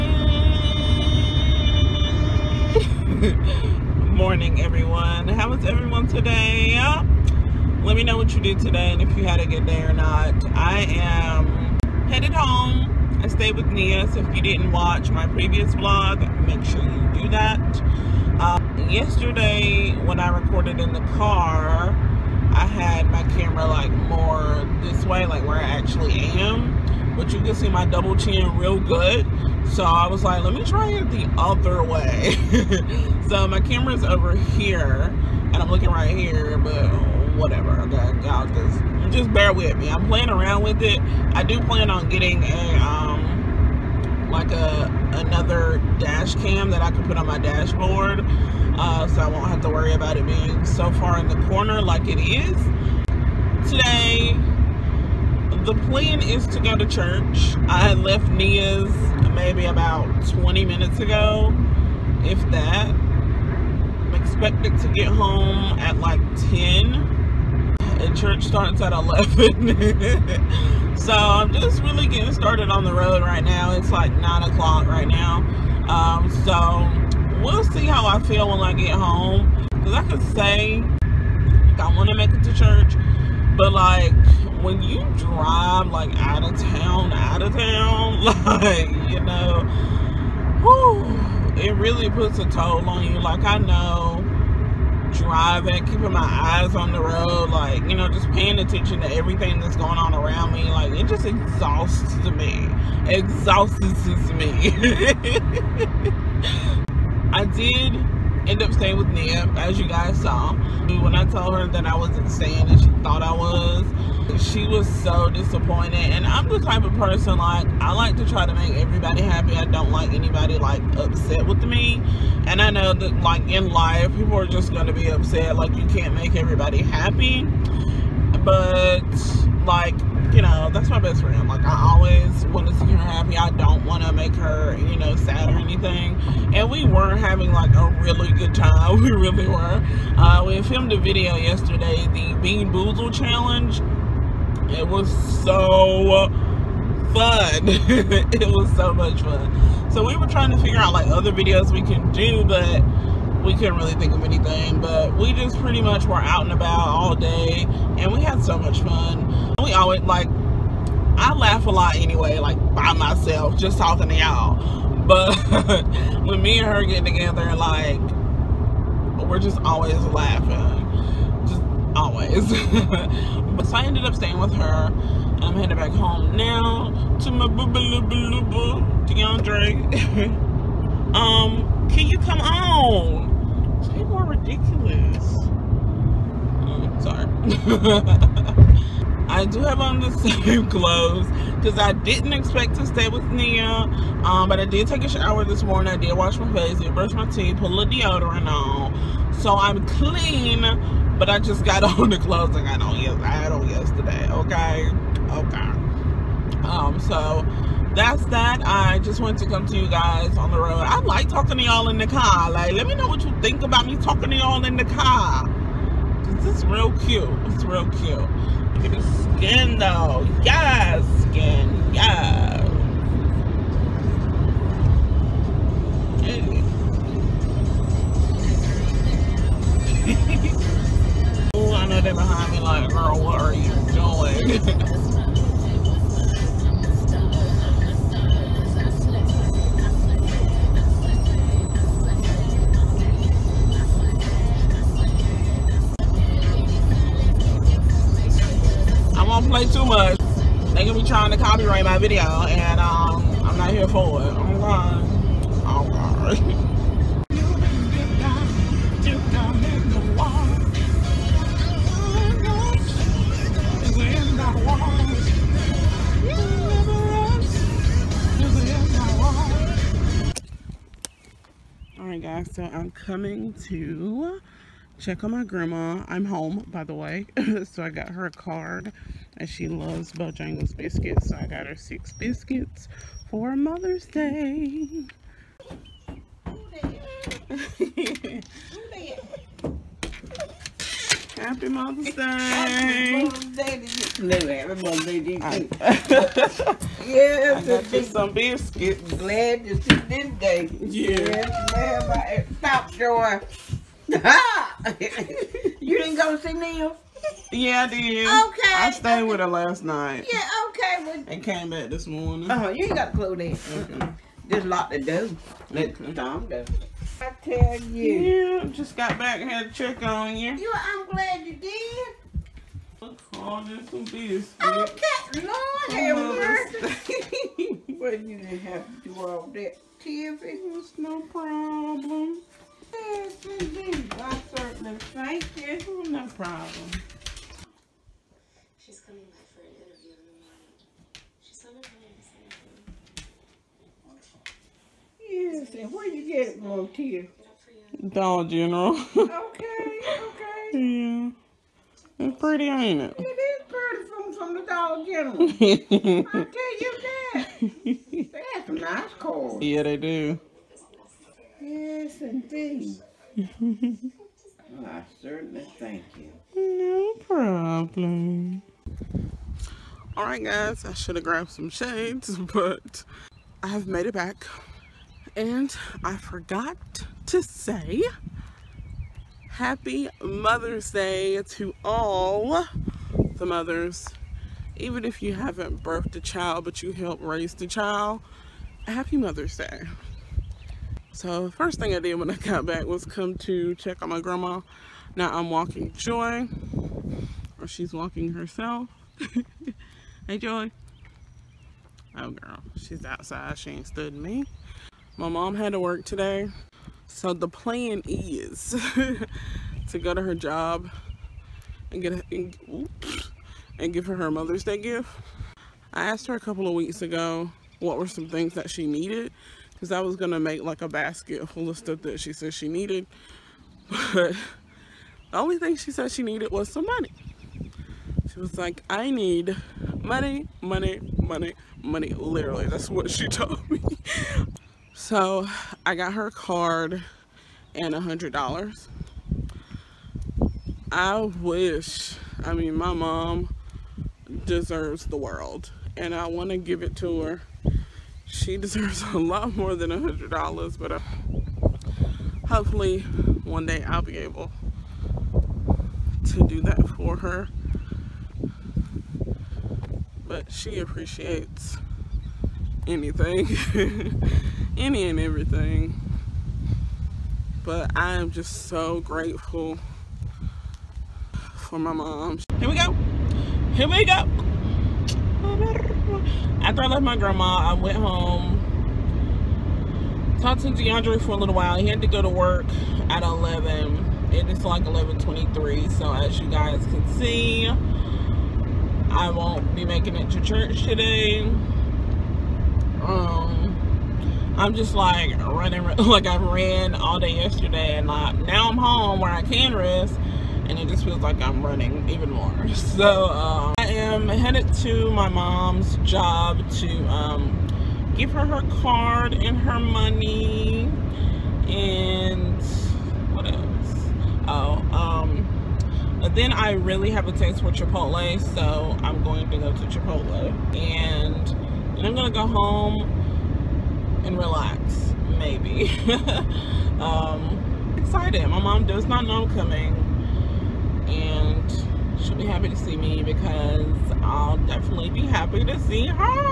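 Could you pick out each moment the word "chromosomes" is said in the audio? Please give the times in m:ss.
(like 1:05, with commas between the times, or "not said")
not said.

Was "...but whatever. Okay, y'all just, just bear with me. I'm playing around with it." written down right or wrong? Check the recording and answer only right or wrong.
right.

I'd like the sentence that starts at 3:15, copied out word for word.
I did wash my face, did brush my teeth, put a little deodorant on.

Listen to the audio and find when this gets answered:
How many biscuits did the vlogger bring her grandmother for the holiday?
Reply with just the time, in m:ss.
4:41.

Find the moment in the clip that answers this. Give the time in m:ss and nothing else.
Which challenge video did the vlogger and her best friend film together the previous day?
2:22.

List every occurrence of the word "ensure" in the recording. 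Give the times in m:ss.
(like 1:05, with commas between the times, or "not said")
not said.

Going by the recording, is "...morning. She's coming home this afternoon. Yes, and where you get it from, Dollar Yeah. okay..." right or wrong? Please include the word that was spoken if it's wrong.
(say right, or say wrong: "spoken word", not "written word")
wrong: "General", not "Yeah".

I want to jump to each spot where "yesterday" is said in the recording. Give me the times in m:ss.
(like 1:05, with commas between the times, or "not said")
0:18, 2:21, 3:23, 8:17.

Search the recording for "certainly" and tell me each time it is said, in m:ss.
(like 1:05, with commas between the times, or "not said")
5:34, 6:05.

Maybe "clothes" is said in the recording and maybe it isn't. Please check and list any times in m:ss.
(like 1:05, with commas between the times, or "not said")
3:10, 3:22.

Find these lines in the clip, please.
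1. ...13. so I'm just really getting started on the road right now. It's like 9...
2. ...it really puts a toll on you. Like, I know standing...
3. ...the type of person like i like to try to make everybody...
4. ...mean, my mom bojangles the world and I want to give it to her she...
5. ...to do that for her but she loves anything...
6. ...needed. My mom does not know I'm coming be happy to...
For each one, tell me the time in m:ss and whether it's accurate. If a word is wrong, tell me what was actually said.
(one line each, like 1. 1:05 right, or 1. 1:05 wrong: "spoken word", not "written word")
1. 1:08 wrong: "11", not "13"
2. 1:31 wrong: "driving", not "standing"
3. 1:56 right
4. 7:22 wrong: "deserves", not "bojangles"
5. 7:36 wrong: "appreciates", not "loves"
6. 8:47 wrong: "excited", not "needed".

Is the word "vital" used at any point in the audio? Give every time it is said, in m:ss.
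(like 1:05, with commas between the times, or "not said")
not said.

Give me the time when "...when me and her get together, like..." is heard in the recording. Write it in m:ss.
2:46.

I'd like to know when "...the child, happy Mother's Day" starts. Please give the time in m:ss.
6:27.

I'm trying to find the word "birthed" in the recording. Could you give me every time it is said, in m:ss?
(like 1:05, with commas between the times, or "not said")
6:25.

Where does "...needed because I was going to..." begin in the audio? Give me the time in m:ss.
6:58.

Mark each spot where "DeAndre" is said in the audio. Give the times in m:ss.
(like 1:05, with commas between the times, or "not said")
2:59, 8:00.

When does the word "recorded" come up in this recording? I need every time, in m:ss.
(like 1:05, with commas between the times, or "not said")
0:20.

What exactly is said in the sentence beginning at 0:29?
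So I was like, let me try it the other way.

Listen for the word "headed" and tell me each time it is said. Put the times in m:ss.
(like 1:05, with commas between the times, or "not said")
0:12, 2:55, 8:24.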